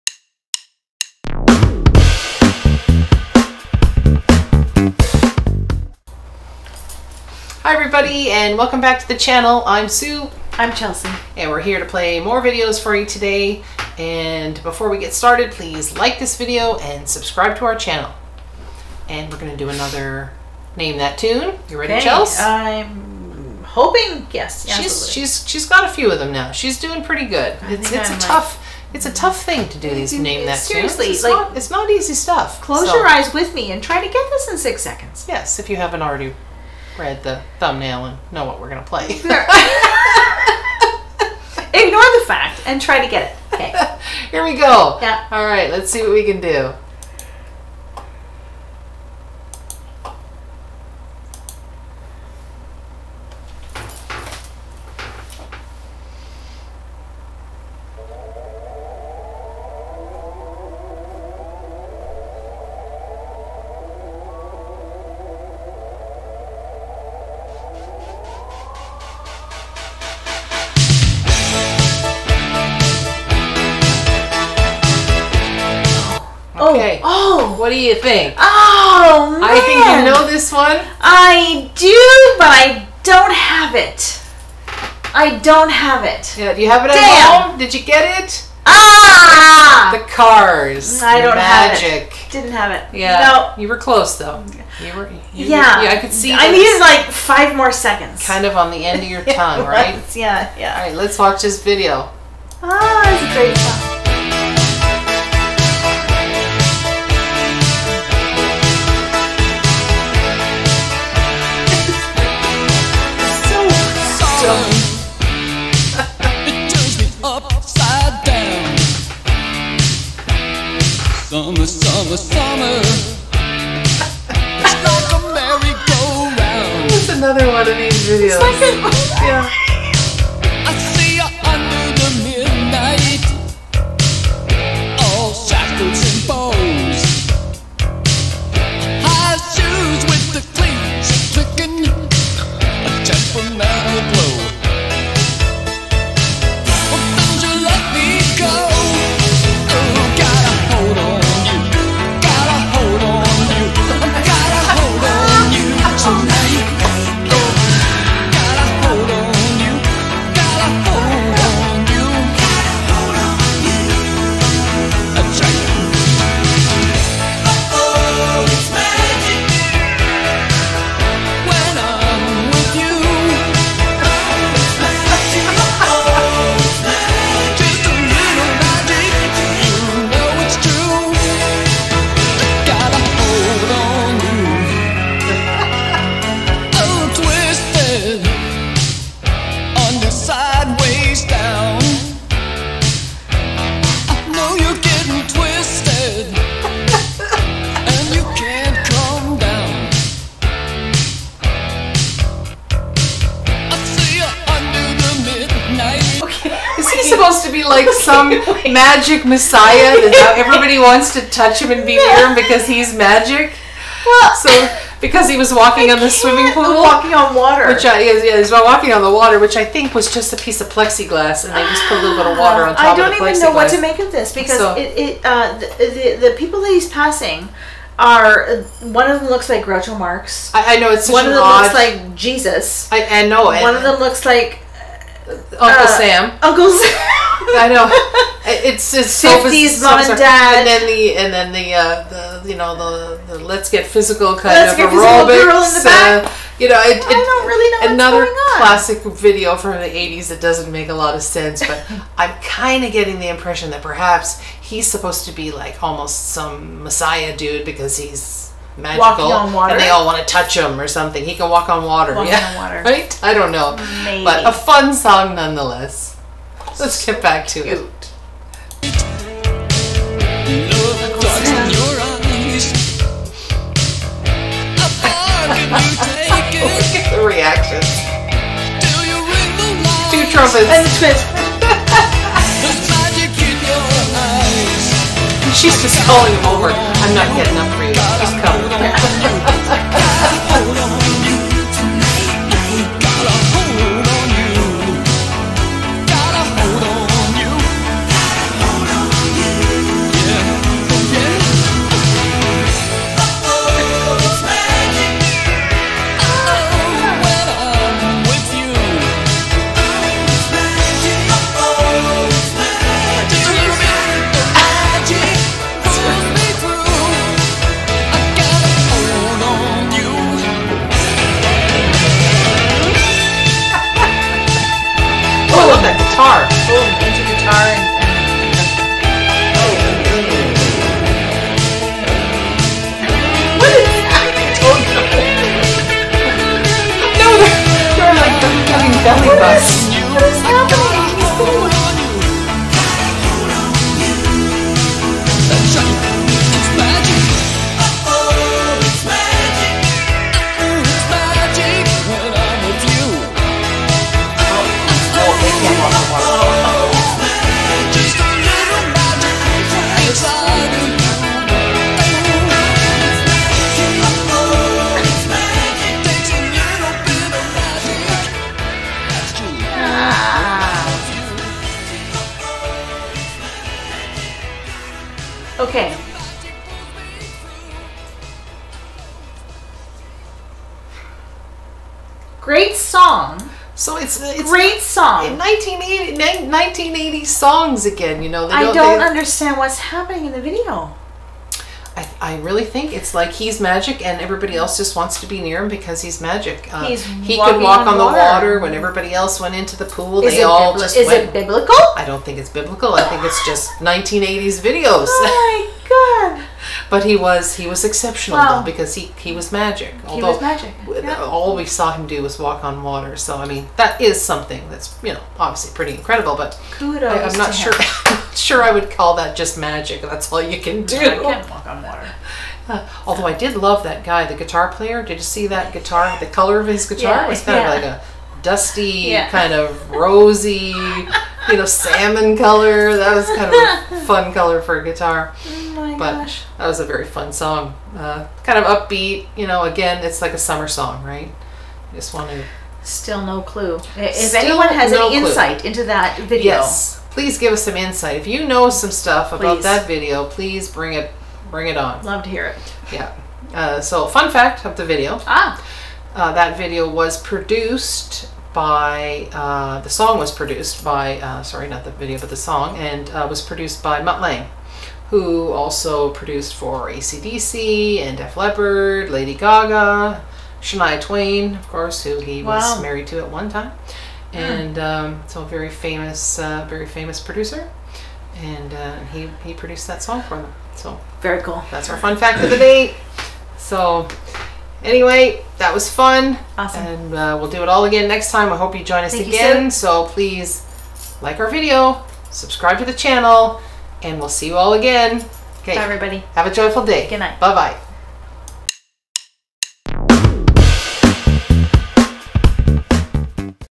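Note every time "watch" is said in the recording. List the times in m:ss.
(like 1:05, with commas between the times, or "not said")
1:41.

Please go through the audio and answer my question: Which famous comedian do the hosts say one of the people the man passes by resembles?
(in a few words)
Groucho Marx.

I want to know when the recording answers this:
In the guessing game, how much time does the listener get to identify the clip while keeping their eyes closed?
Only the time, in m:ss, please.
0:34.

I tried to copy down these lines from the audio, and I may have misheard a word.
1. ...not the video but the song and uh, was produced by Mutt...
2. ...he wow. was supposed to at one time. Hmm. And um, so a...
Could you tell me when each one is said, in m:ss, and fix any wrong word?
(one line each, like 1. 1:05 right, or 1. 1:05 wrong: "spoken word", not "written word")
1. 7:41 right
2. 7:52 wrong: "married", not "supposed".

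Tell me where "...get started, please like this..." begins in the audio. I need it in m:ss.
0:14.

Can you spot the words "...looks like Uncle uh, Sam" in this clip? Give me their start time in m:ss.
3:53.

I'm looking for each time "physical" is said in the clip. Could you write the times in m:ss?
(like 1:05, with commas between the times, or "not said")
4:03.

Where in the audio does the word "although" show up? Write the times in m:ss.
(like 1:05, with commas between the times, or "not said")
6:50, 7:03.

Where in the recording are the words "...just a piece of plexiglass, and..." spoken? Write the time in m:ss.
3:40.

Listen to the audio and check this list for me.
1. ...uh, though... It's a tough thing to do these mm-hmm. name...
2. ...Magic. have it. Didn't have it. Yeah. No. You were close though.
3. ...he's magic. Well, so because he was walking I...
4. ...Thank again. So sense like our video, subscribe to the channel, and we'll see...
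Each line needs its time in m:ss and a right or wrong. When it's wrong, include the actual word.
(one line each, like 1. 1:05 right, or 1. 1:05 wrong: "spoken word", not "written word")
1. 0:28 wrong: "tough", not "though"
2. 1:31 right
3. 3:32 right
4. 8:09 wrong: "please", not "sense".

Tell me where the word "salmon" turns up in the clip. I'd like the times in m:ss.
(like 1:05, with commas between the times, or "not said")
7:11.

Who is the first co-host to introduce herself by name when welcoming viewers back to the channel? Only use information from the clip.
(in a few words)
Sue.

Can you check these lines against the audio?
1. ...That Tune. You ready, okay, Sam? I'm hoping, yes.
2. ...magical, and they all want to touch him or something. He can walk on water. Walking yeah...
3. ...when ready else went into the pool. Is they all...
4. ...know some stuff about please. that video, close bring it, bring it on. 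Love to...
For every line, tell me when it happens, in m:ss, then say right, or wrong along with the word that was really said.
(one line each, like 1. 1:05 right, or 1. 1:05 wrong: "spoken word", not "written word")
1. 0:20 wrong: "Chelsea", not "Sam"
2. 4:18 right
3. 6:38 wrong: "everybody", not "ready"
4. 7:28 wrong: "please", not "close".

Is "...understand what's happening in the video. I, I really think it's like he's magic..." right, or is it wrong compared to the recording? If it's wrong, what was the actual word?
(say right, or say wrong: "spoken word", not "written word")
right.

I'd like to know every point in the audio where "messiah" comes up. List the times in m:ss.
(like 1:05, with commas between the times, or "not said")
3:29, 4:16.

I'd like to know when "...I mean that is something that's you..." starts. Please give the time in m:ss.
6:53.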